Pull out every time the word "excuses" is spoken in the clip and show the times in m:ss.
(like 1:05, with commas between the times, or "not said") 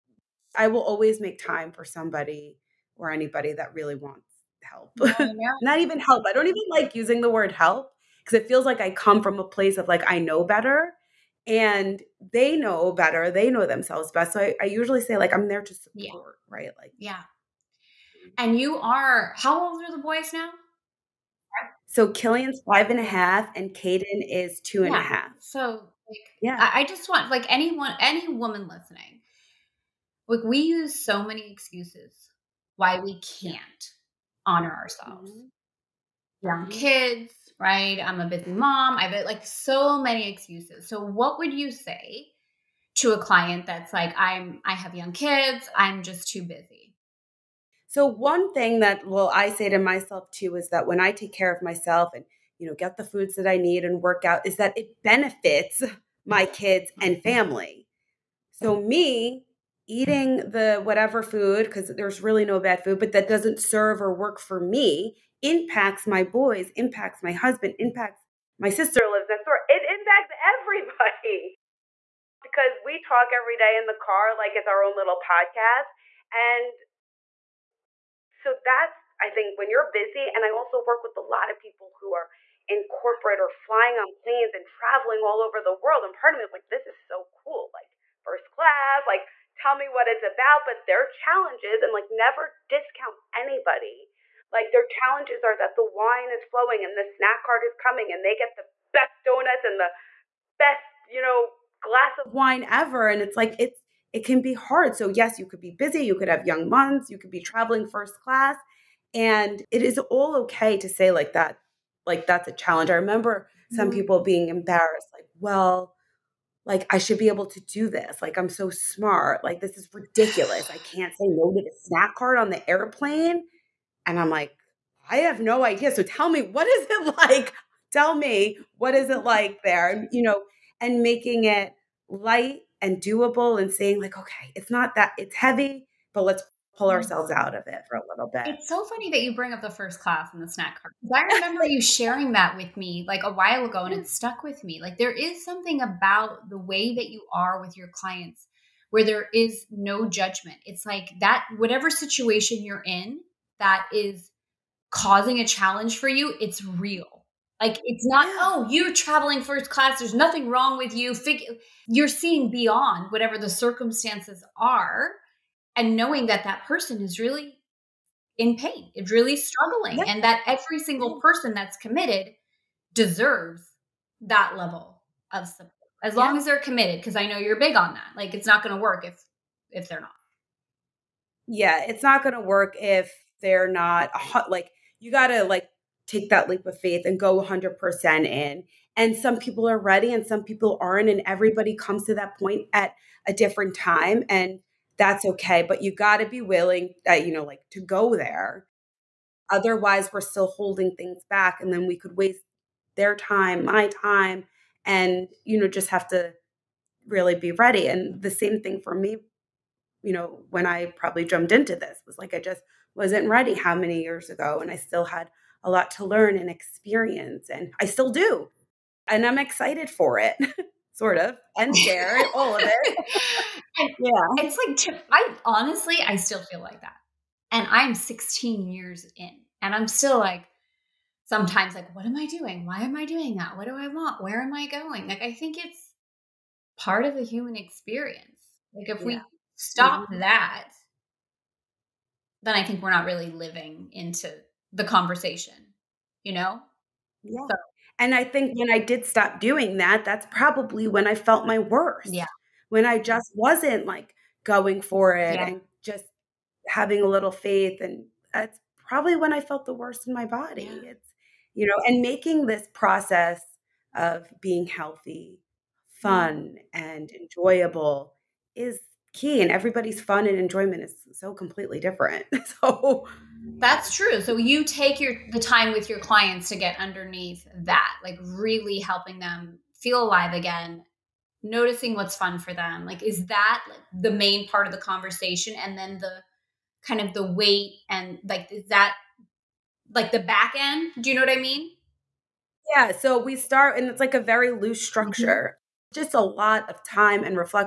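0:31, 0:40.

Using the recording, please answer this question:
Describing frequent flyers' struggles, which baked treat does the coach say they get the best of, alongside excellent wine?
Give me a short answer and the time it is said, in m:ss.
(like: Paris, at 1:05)
Donuts, at 1:39.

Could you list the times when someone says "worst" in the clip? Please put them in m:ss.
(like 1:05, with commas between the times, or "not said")
4:11, 4:19.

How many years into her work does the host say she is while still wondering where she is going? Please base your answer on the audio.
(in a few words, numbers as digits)
16.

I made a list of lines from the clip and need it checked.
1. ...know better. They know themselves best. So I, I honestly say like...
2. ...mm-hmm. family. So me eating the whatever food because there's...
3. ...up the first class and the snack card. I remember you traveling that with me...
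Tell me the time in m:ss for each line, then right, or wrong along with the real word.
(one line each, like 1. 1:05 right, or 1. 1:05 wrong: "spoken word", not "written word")
1. 0:12 wrong: "usually", not "honestly"
2. 0:57 right
3. 2:19 wrong: "sharing", not "traveling".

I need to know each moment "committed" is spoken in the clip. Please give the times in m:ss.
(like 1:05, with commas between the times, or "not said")
2:51, 2:56.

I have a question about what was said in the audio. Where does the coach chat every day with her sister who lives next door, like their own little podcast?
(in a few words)
In the car.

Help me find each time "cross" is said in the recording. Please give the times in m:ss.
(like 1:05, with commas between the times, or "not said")
not said.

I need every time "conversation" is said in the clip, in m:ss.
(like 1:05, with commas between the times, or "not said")
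4:04, 4:44.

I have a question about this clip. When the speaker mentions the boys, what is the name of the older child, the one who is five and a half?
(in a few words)
Killian.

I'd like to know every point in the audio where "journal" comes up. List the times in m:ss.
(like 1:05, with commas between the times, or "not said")
not said.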